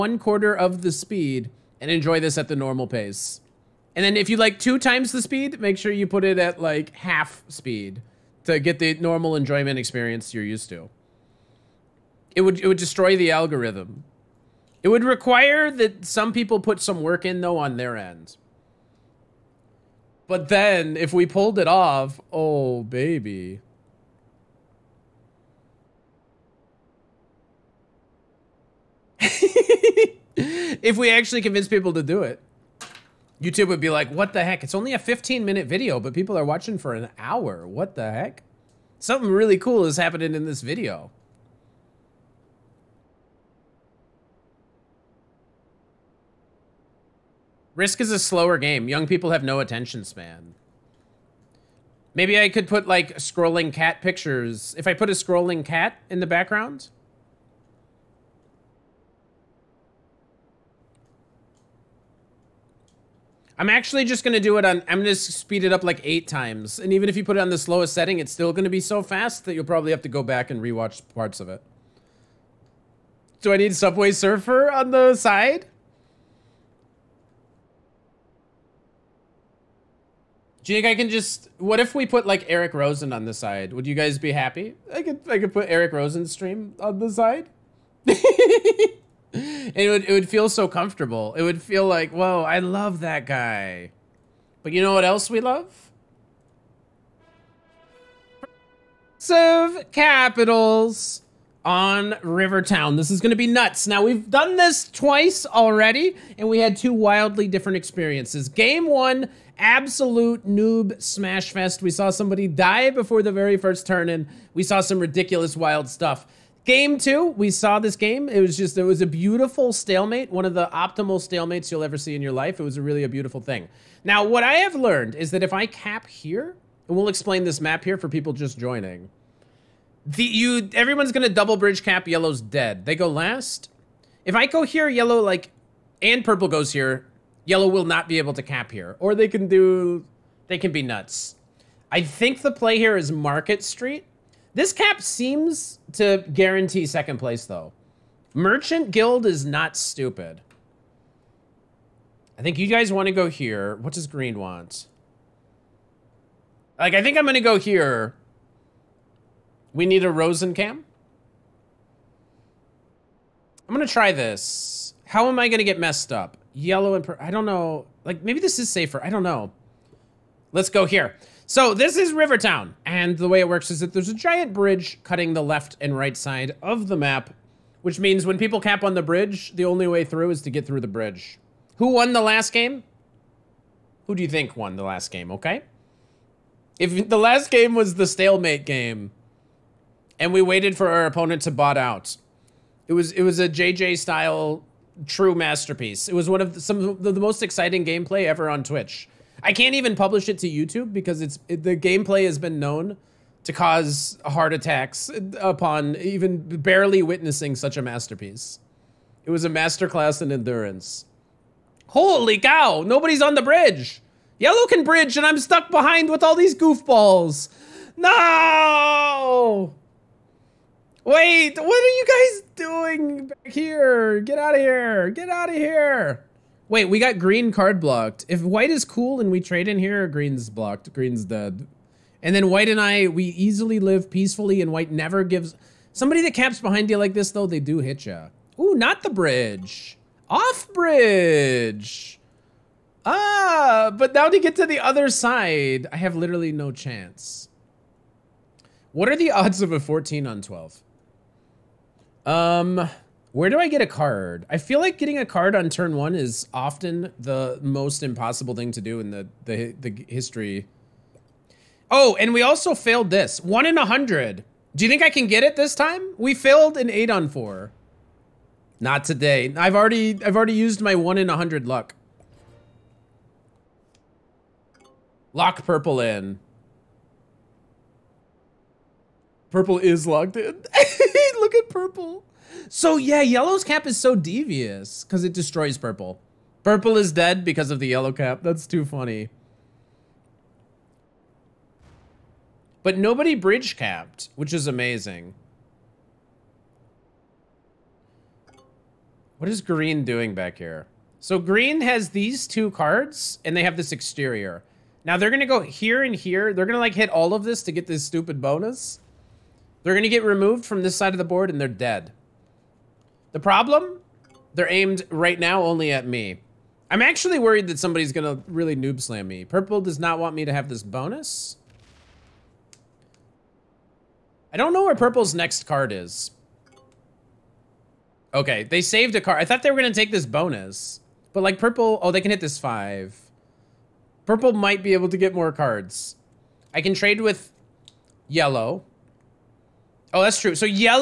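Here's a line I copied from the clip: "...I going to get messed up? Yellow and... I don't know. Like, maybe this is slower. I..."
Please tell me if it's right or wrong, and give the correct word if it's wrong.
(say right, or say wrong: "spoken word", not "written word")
wrong: "safer", not "slower".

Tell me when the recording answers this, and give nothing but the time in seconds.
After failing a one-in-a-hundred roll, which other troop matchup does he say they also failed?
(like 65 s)
266 s.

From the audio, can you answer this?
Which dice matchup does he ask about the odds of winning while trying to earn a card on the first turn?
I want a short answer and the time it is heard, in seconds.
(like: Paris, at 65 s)
14 on 12, at 249 s.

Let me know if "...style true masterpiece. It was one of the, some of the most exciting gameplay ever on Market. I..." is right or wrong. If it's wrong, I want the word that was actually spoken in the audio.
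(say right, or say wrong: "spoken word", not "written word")
wrong: "Twitch", not "Market".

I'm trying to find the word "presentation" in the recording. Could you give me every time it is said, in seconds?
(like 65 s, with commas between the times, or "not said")
not said.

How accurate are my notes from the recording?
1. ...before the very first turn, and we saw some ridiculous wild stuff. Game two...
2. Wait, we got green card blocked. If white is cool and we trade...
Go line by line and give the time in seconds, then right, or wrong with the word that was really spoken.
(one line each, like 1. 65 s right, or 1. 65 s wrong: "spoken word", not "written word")
1. 112 s right
2. 226 s right.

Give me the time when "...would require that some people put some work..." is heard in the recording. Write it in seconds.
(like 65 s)
14 s.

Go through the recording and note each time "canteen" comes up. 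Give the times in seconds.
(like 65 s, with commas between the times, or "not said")
not said.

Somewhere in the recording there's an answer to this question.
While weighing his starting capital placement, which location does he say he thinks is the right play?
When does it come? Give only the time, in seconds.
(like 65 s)
143 s.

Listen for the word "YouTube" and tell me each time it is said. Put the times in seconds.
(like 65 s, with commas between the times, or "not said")
33 s, 200 s.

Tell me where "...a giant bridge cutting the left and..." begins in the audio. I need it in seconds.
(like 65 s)
174 s.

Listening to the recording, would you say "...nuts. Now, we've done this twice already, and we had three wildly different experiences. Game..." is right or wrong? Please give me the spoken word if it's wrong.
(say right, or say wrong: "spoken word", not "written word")
wrong: "two", not "three".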